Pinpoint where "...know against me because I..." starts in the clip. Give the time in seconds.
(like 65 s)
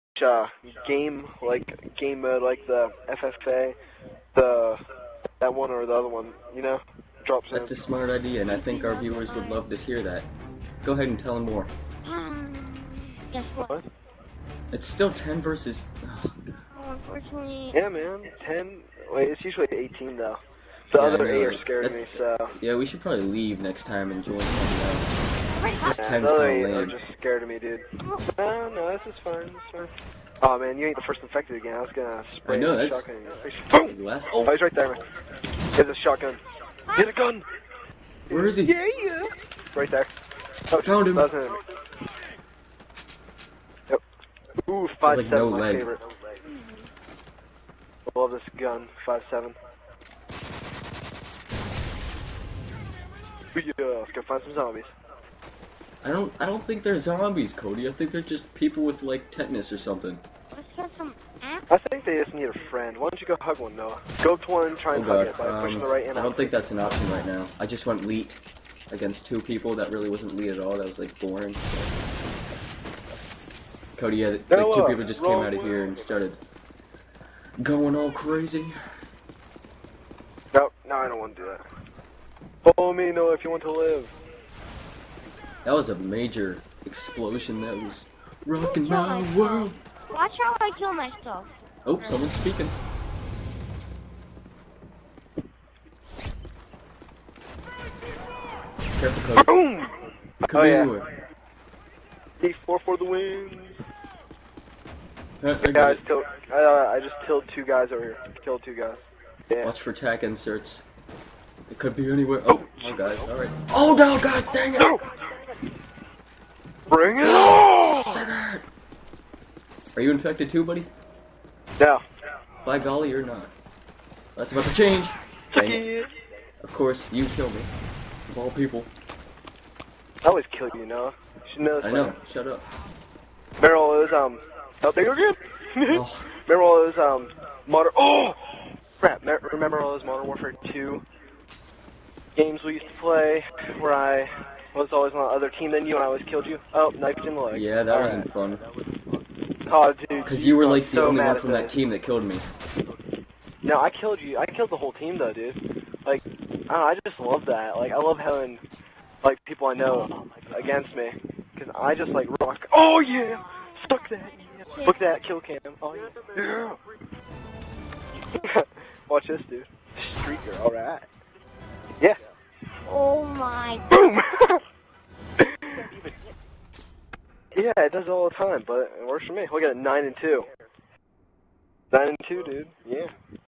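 159 s.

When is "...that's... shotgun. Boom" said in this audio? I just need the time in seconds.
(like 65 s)
32 s.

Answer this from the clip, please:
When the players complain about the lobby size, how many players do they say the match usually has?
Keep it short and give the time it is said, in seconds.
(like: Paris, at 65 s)
18, at 19 s.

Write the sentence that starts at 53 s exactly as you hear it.
Yeah, let's go find some zombies.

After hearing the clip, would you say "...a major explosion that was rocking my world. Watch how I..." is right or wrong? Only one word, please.
right.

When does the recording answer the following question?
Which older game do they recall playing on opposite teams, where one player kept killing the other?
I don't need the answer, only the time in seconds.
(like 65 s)
140 s.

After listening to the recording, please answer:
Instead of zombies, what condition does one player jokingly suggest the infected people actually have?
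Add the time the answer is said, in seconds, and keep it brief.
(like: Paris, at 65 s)
Tetanus, at 59 s.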